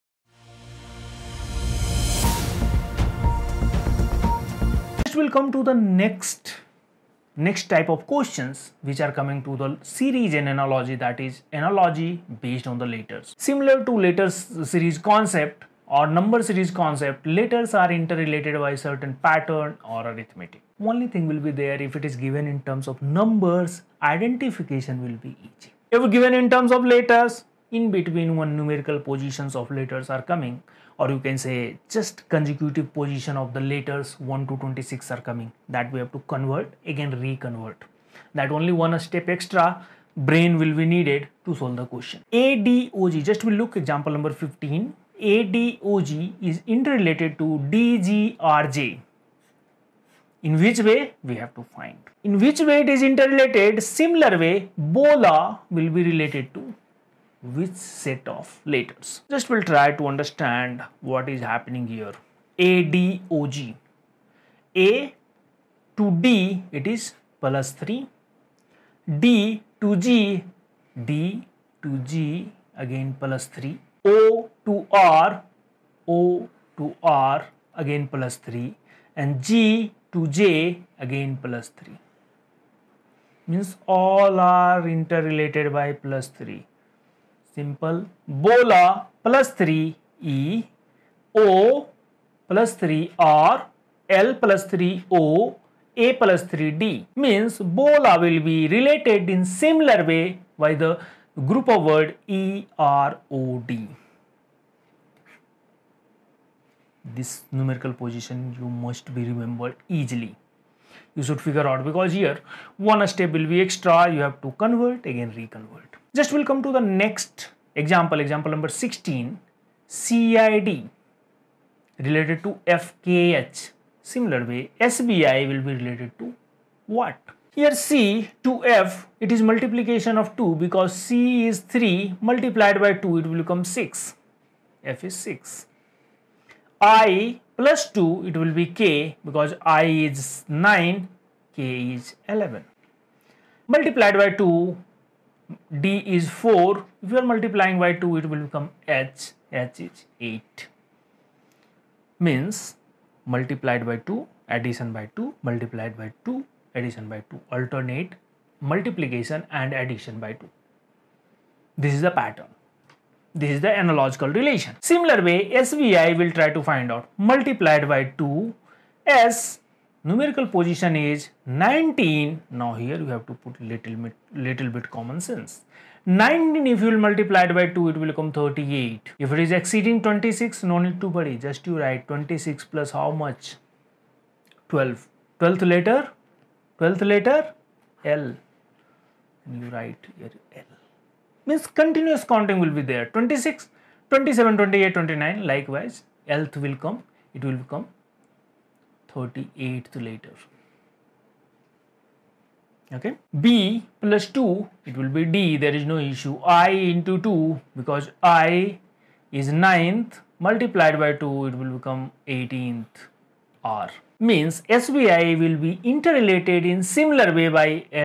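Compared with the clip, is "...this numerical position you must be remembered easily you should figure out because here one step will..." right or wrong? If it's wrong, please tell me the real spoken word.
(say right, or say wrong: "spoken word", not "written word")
right.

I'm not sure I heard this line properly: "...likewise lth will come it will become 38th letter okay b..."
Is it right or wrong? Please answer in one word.
wrong.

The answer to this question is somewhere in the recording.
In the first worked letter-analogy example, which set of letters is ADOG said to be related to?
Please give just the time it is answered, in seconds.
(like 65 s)
47 s.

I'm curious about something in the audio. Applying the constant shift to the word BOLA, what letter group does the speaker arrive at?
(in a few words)
EROD.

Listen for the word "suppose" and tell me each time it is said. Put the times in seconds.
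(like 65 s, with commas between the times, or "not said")
not said.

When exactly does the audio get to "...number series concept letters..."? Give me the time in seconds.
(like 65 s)
16 s.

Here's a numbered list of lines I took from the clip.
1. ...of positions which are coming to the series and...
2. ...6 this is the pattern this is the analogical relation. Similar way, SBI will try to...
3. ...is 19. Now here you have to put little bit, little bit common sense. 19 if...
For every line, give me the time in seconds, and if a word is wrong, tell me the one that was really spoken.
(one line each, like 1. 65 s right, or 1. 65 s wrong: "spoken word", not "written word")
1. 7 s wrong: "questions", not "positions"
2. 160 s wrong: "2", not "6"
3. 170 s right.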